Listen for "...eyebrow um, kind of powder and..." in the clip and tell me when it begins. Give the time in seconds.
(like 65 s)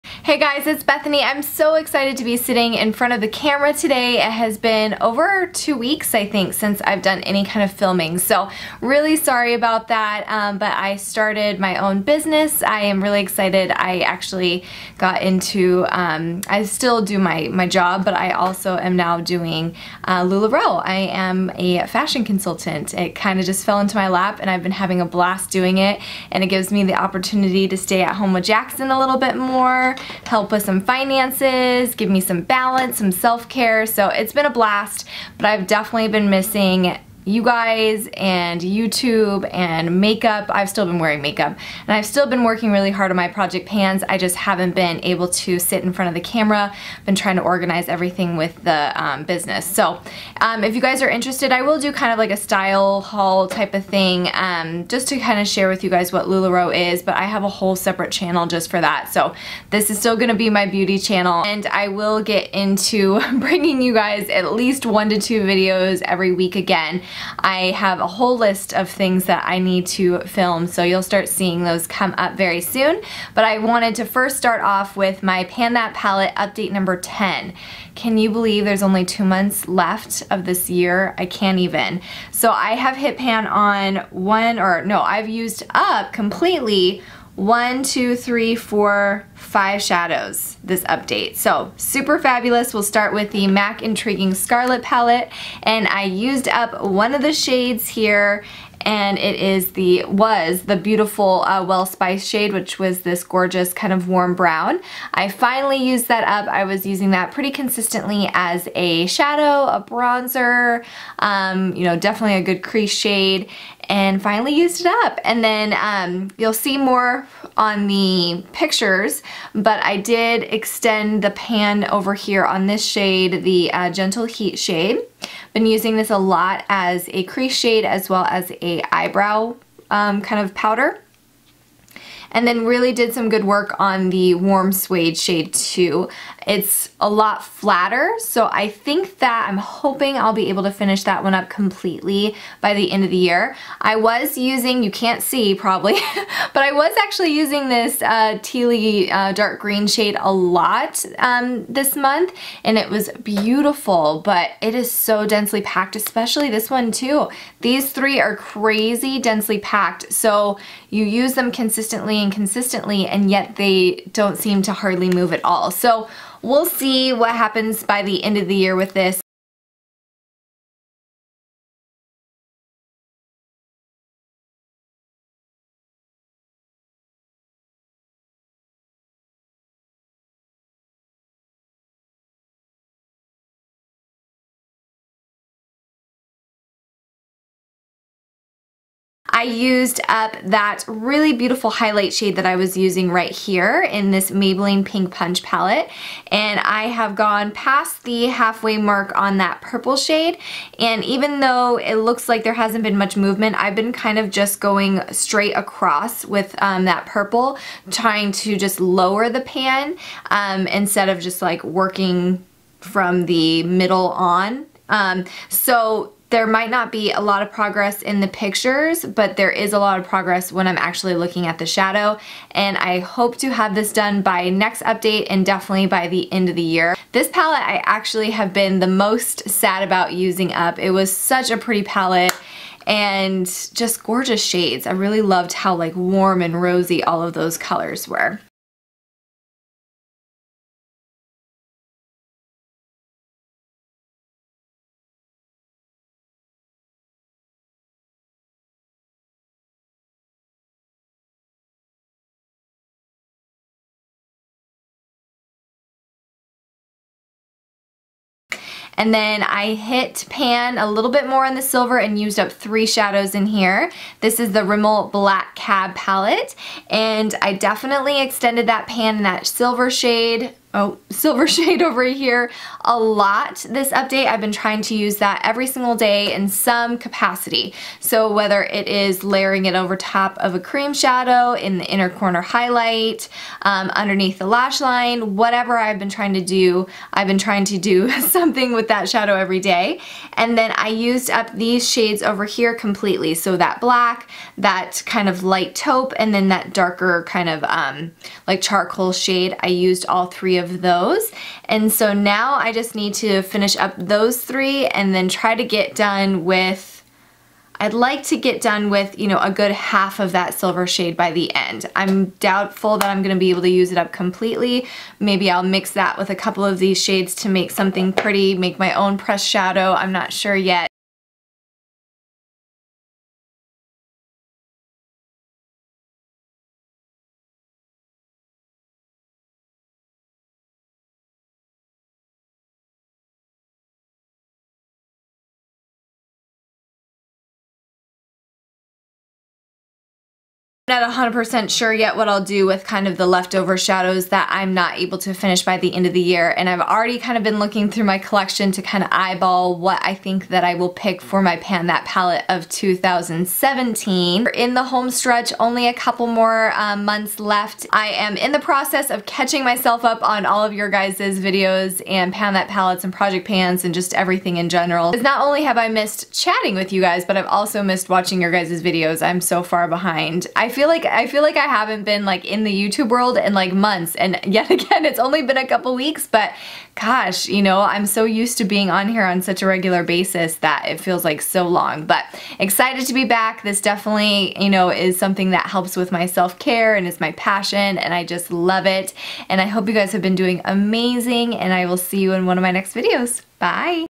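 128 s.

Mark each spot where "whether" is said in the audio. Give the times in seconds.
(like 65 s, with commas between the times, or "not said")
278 s.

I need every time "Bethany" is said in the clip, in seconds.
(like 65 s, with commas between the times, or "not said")
0 s.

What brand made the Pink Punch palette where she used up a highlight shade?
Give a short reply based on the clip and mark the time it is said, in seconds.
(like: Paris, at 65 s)
Maybelline, at 194 s.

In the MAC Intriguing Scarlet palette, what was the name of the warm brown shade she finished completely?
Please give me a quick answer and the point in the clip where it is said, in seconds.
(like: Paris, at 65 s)
Well Spice, at 101 s.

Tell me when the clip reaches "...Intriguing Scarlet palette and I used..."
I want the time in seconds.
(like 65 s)
93 s.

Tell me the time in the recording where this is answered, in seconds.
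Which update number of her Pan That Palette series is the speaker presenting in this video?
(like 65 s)
76 s.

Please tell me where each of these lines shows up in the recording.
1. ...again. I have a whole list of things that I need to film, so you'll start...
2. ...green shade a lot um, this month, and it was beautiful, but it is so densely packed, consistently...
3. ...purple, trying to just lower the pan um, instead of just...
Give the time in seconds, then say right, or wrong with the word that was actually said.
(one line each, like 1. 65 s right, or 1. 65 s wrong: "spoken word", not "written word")
1. 66 s right
2. 149 s wrong: "especially", not "consistently"
3. 207 s right.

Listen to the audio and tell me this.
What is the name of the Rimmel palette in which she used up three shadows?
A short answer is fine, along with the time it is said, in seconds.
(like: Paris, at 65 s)
Black Cab, at 265 s.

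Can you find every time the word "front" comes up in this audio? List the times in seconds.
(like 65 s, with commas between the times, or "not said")
2 s, 45 s.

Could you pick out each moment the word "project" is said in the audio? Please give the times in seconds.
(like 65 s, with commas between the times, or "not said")
43 s, 363 s.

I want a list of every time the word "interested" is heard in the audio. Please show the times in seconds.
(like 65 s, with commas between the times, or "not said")
51 s.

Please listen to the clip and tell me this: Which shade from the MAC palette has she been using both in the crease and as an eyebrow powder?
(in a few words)
Gentle Heat.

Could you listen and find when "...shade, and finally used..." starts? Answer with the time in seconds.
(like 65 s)
112 s.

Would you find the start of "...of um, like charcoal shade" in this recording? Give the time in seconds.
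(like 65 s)
297 s.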